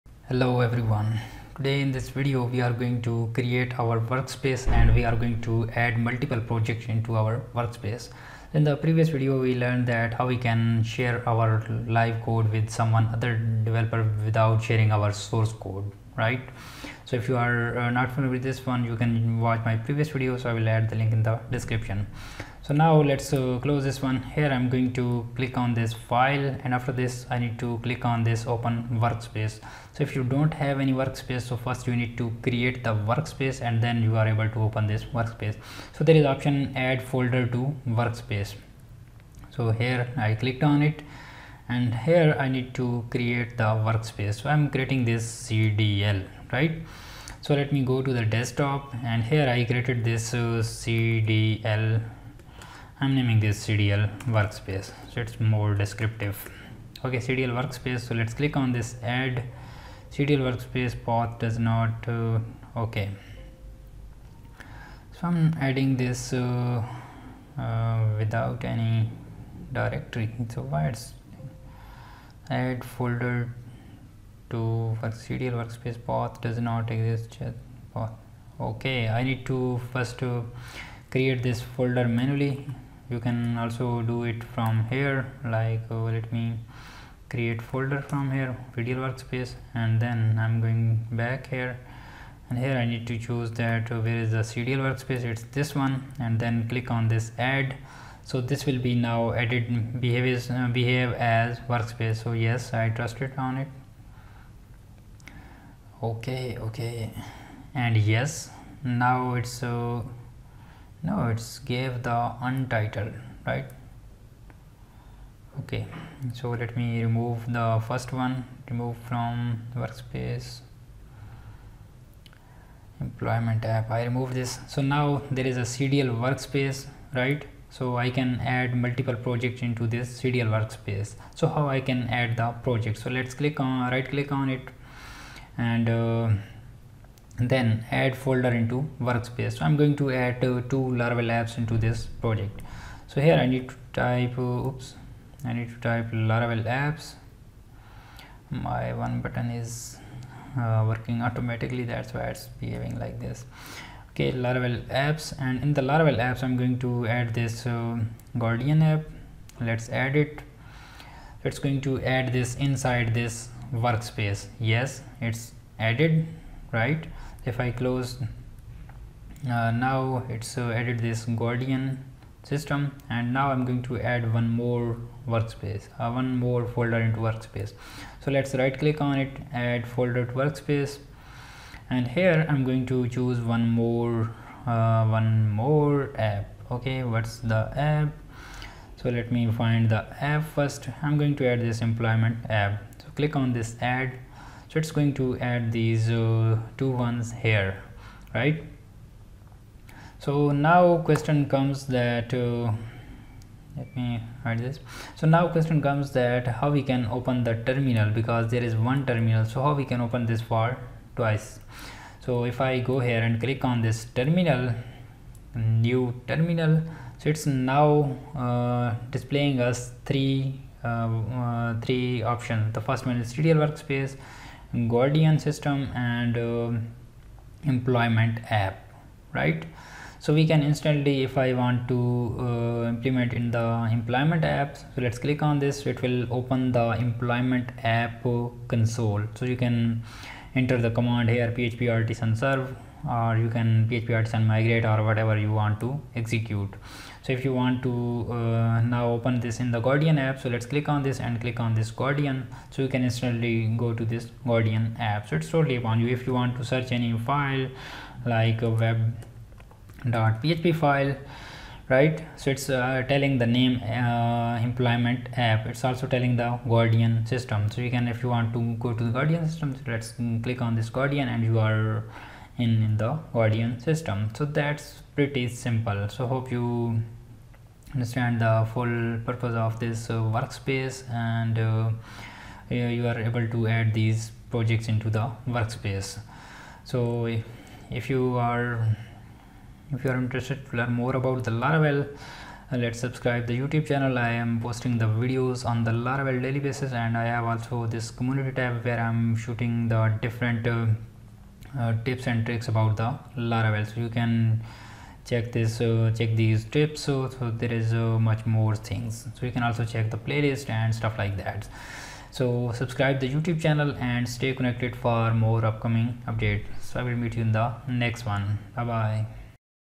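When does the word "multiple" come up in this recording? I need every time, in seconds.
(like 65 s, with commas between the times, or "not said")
6 s, 128 s.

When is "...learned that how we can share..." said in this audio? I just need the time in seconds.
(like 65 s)
9 s.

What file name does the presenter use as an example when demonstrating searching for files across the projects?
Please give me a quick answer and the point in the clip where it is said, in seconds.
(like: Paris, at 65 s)
web.php, at 258 s.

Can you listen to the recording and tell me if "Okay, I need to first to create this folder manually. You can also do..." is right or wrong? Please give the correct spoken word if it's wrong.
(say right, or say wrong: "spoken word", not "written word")
right.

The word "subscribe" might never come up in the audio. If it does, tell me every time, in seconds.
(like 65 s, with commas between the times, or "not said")
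293 s, 312 s.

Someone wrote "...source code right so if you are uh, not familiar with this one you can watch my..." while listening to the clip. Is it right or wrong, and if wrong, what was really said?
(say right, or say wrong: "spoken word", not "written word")
right.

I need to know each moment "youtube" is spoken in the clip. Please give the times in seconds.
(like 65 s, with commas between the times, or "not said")
293 s, 313 s.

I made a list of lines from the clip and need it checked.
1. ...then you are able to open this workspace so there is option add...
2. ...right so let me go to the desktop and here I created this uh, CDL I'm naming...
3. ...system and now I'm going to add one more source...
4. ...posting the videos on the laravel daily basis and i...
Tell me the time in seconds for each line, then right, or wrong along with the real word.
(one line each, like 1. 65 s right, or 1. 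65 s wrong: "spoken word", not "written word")
1. 33 s right
2. 46 s right
3. 172 s wrong: "workspace", not "source"
4. 294 s right.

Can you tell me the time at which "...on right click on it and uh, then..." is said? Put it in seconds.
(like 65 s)
133 s.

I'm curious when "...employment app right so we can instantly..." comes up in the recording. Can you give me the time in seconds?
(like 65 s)
227 s.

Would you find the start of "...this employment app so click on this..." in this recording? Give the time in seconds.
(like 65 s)
191 s.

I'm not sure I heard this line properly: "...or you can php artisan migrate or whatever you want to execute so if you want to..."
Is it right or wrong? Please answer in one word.
right.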